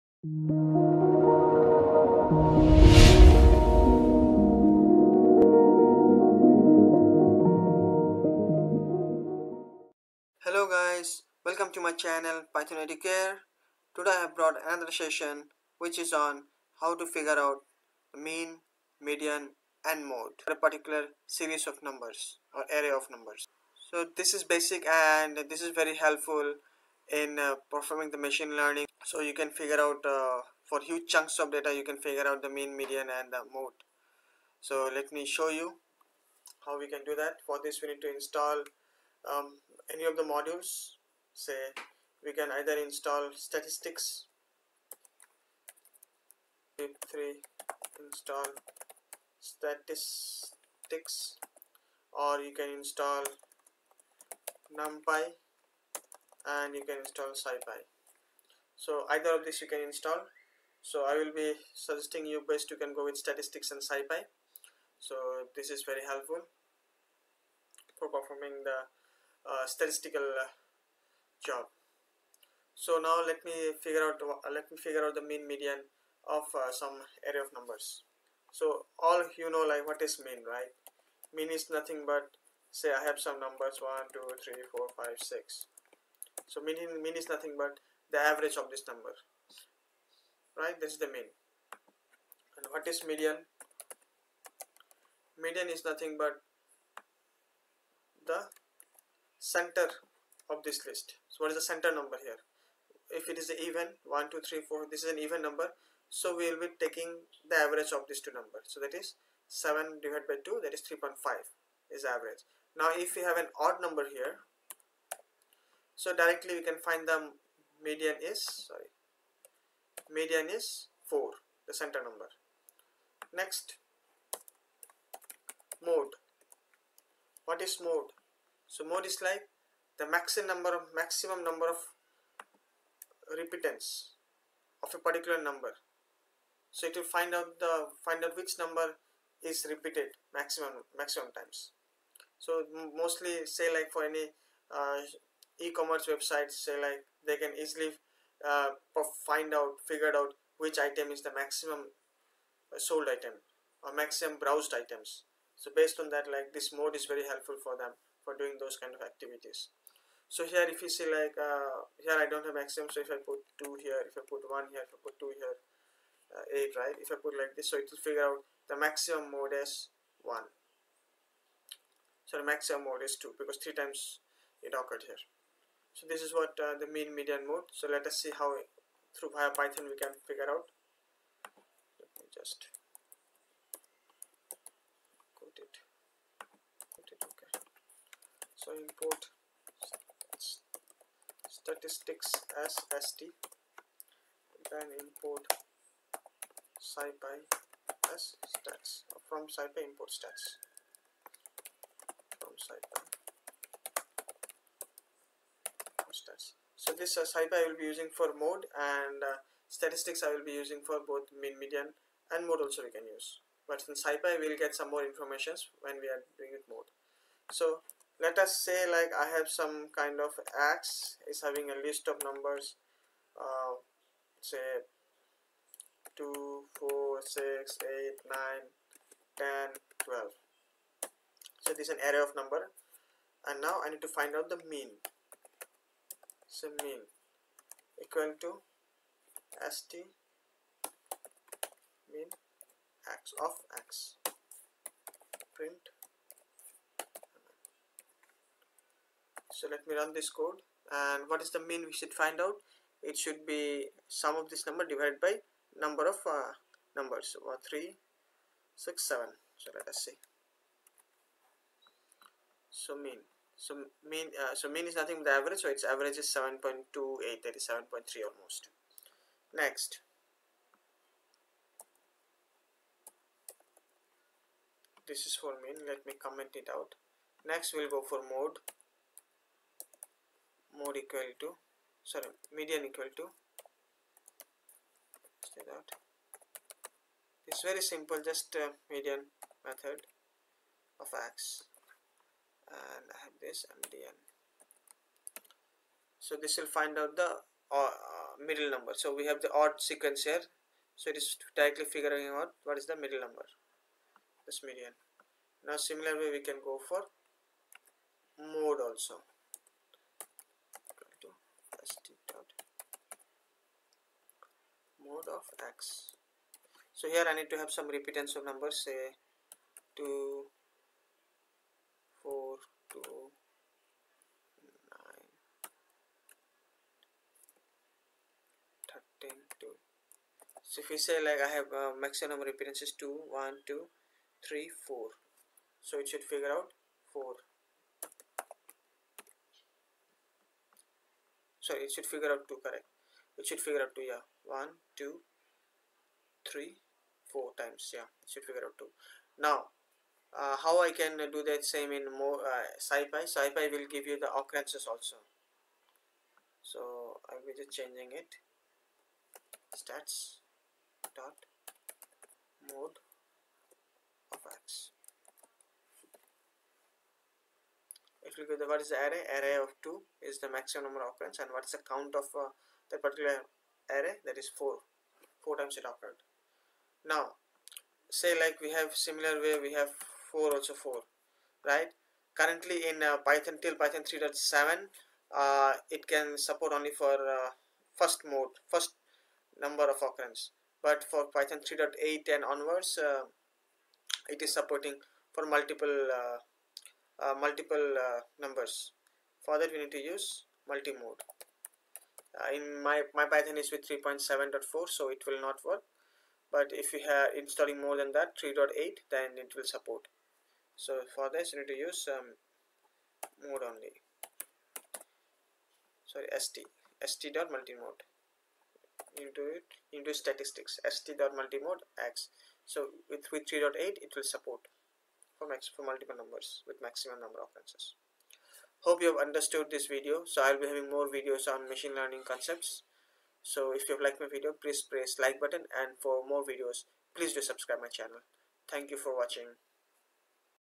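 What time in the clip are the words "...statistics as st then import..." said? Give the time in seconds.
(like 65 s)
191 s.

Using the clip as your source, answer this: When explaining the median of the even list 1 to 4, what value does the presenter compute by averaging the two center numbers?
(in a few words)
3.5.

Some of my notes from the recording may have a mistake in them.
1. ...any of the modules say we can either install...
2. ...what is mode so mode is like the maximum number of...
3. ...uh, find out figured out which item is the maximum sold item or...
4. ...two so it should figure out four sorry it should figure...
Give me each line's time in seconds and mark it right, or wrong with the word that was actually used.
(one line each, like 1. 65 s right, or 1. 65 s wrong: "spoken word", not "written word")
1. 39 s right
2. 127 s right
3. 148 s right
4. 334 s wrong: "four", not "two".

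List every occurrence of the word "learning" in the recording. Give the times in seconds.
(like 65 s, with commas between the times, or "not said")
28 s, 431 s.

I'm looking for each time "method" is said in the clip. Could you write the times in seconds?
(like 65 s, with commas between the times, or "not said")
289 s.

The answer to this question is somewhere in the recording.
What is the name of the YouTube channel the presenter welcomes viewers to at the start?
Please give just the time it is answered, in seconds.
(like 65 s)
12 s.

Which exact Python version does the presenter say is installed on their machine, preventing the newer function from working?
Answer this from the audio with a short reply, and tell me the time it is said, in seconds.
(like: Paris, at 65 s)
3.7.4, at 403 s.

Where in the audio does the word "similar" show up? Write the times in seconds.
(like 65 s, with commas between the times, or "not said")
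305 s, 378 s.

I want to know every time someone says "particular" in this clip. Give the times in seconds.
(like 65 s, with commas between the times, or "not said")
20 s, 135 s, 372 s.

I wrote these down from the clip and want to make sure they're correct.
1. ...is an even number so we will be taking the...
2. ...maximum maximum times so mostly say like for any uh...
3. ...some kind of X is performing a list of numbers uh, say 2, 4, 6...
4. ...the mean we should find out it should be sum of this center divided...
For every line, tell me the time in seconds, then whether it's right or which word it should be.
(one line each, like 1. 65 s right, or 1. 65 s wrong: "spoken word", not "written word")
1. 105 s right
2. 140 s right
3. 219 s wrong: "having", not "performing"
4. 251 s wrong: "number", not "center".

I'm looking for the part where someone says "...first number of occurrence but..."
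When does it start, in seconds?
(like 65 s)
388 s.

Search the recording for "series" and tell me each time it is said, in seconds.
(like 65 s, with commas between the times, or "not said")
21 s.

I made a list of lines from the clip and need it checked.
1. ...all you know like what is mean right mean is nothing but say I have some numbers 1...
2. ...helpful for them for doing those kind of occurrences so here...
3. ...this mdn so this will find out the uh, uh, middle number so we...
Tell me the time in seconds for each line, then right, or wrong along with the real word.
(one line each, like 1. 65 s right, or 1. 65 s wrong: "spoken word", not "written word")
1. 78 s right
2. 157 s wrong: "activities", not "occurrences"
3. 293 s right.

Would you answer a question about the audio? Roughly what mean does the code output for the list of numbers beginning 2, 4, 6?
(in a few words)
7.28.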